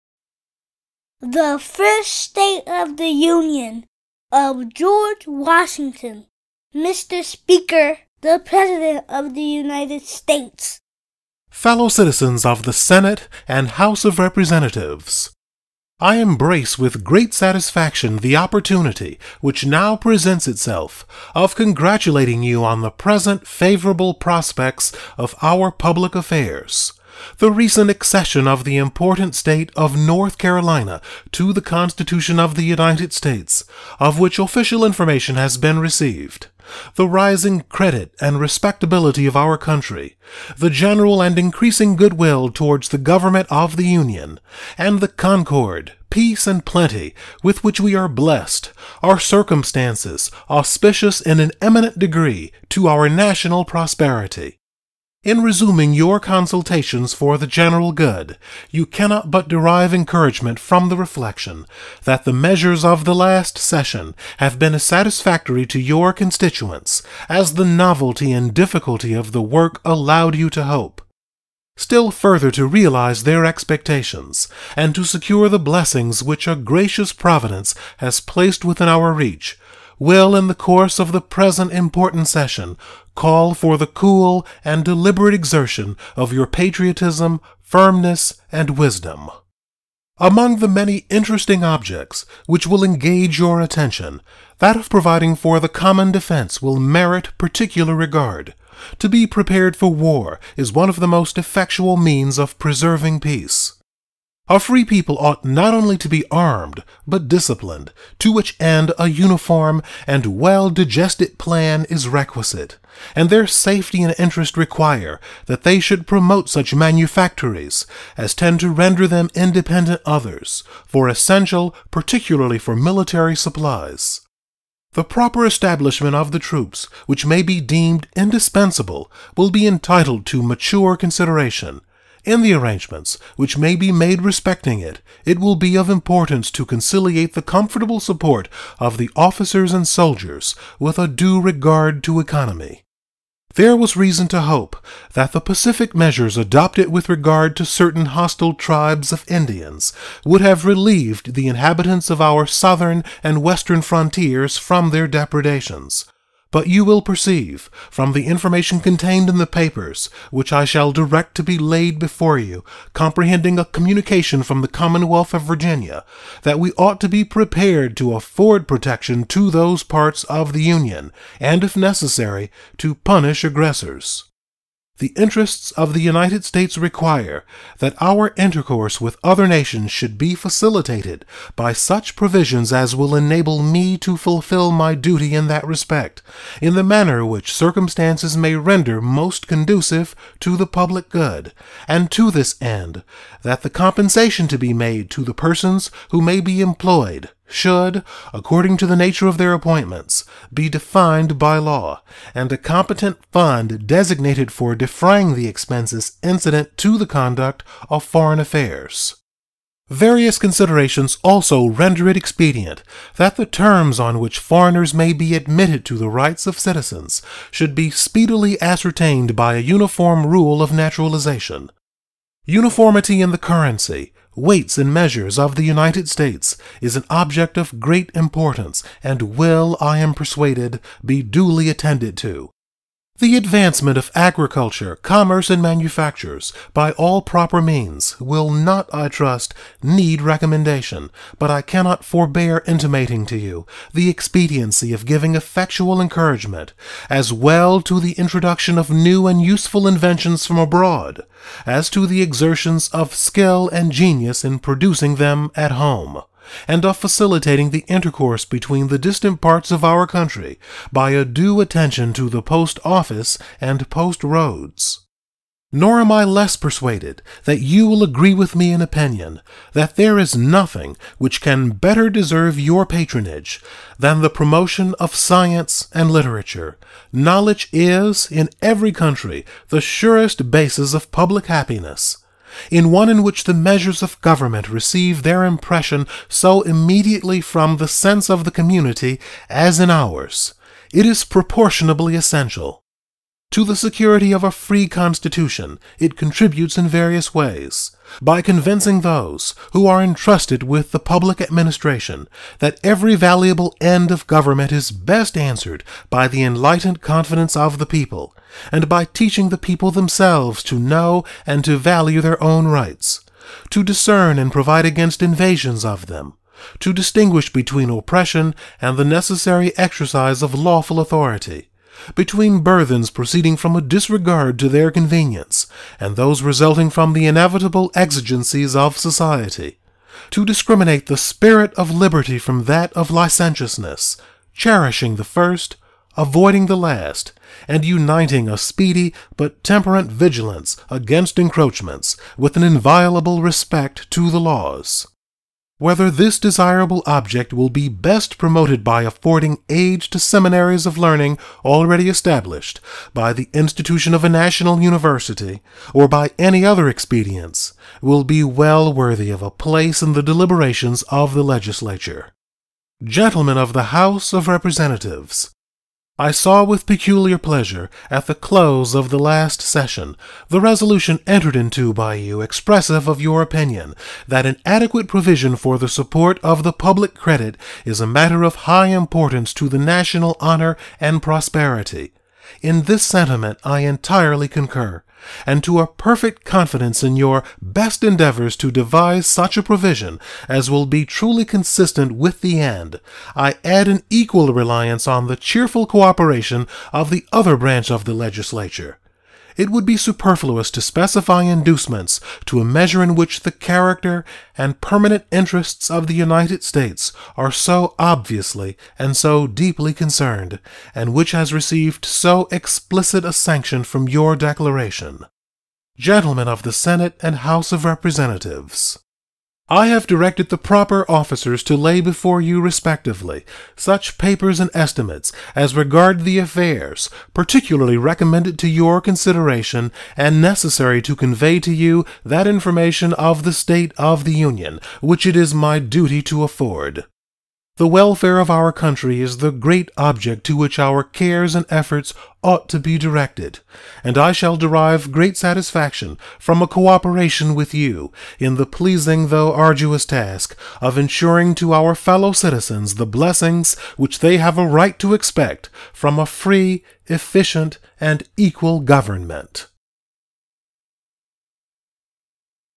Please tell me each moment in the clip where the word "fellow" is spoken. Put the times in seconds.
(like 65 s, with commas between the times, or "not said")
11 s, 451 s.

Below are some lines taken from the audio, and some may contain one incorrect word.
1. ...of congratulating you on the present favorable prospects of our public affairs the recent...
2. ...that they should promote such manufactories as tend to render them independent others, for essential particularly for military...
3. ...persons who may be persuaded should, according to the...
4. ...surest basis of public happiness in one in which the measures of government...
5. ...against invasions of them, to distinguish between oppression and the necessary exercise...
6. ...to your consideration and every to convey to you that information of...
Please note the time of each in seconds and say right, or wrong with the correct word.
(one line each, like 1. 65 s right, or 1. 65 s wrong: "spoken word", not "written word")
1. 21 s right
2. 115 s right
3. 195 s wrong: "employed", not "persuaded"
4. 279 s right
5. 314 s right
6. 428 s wrong: "necessary", not "every".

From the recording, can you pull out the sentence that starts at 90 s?
Among the many interesting objects which will engage your attention, that of providing for the common defense will merit particular regard.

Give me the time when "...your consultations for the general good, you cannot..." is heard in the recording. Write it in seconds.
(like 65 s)
55 s.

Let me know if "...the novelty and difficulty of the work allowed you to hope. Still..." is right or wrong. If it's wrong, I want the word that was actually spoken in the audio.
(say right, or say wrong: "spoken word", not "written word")
right.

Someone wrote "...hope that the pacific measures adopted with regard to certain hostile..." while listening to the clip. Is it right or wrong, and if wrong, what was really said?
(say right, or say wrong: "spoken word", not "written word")
right.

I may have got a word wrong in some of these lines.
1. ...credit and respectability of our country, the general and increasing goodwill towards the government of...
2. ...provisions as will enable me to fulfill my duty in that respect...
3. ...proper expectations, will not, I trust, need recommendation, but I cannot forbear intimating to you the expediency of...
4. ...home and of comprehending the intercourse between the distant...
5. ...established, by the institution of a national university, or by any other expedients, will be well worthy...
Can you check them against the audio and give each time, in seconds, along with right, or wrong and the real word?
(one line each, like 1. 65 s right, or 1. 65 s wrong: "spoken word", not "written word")
1. 37 s right
2. 182 s right
3. 237 s wrong: "means", not "expectations"
4. 255 s wrong: "facilitating", not "comprehending"
5. 352 s right.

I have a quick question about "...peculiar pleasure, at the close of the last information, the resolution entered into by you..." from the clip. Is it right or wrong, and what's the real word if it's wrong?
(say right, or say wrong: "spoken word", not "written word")
wrong: "session", not "information".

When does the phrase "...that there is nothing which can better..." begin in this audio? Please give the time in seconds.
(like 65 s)
269 s.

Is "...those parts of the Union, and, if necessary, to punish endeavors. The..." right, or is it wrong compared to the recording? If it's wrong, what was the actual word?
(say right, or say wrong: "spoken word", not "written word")
wrong: "aggressors", not "endeavors".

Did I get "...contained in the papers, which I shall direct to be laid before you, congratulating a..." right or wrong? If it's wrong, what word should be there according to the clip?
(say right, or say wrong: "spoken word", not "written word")
wrong: "comprehending", not "congratulating".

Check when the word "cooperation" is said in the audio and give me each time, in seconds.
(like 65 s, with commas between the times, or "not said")
395 s, 446 s.